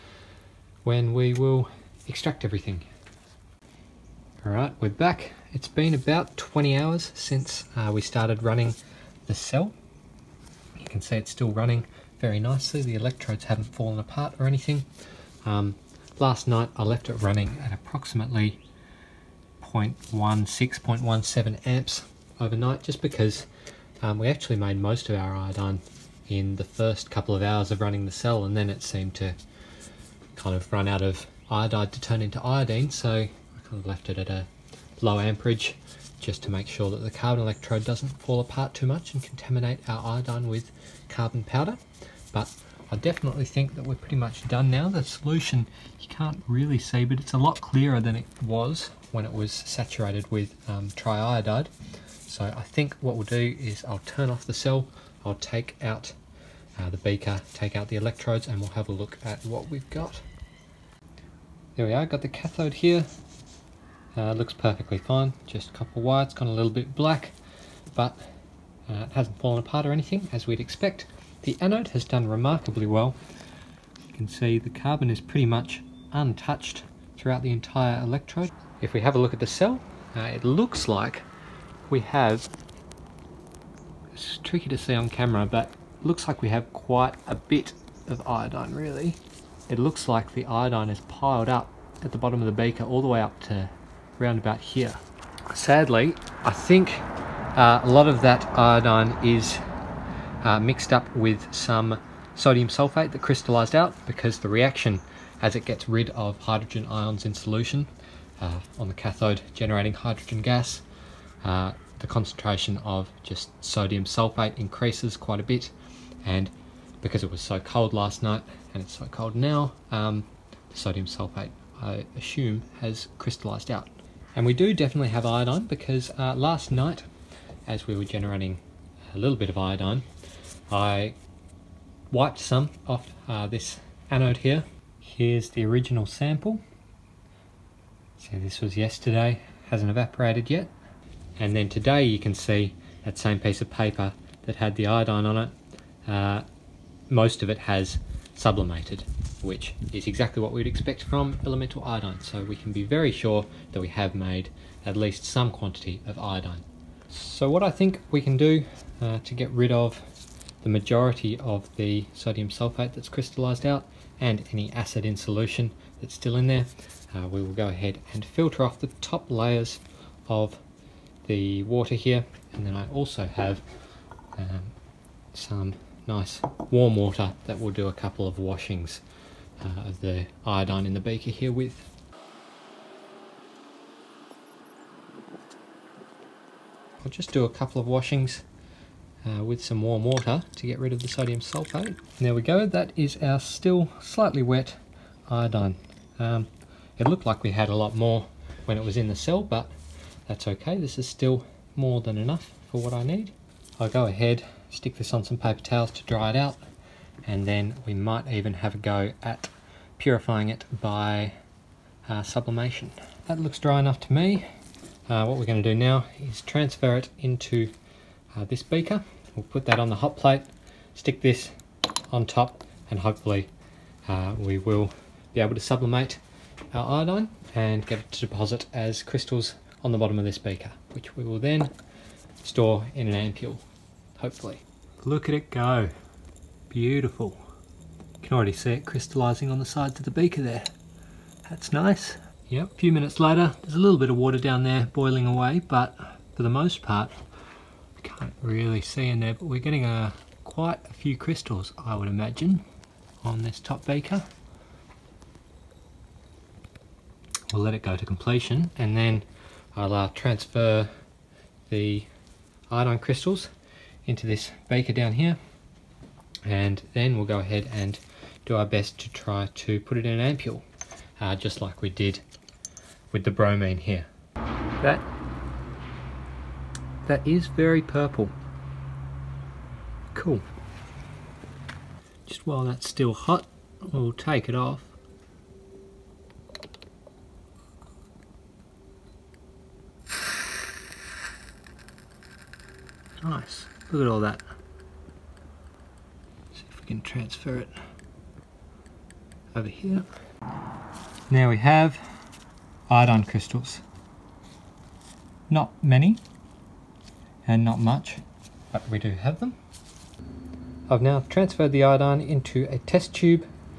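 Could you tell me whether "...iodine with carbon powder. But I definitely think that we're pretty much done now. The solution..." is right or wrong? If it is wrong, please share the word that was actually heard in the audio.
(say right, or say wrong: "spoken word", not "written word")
right.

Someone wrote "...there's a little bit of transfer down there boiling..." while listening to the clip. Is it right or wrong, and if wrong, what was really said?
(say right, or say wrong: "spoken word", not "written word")
wrong: "water", not "transfer".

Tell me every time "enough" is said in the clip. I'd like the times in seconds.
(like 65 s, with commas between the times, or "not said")
202 s, 213 s.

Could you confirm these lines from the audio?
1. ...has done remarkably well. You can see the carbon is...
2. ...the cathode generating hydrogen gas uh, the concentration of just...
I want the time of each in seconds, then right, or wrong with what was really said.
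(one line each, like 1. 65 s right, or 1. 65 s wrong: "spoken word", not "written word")
1. 71 s right
2. 108 s right.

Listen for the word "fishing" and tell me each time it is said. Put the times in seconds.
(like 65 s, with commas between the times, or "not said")
not said.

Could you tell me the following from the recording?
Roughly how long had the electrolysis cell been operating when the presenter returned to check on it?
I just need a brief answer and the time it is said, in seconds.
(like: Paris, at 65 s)
20 hours, at 5 s.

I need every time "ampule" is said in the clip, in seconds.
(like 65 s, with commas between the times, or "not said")
233 s, 270 s.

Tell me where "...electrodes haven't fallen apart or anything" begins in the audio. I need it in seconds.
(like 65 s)
12 s.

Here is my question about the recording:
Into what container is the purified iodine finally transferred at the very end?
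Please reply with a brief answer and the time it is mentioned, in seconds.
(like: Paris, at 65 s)
test tube, at 312 s.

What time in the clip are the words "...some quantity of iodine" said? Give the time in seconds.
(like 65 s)
155 s.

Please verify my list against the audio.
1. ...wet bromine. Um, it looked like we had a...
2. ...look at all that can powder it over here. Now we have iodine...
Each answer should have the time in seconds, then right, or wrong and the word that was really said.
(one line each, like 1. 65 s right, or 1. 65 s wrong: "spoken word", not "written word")
1. 194 s wrong: "iodine", not "bromine"
2. 293 s wrong: "transfer", not "powder".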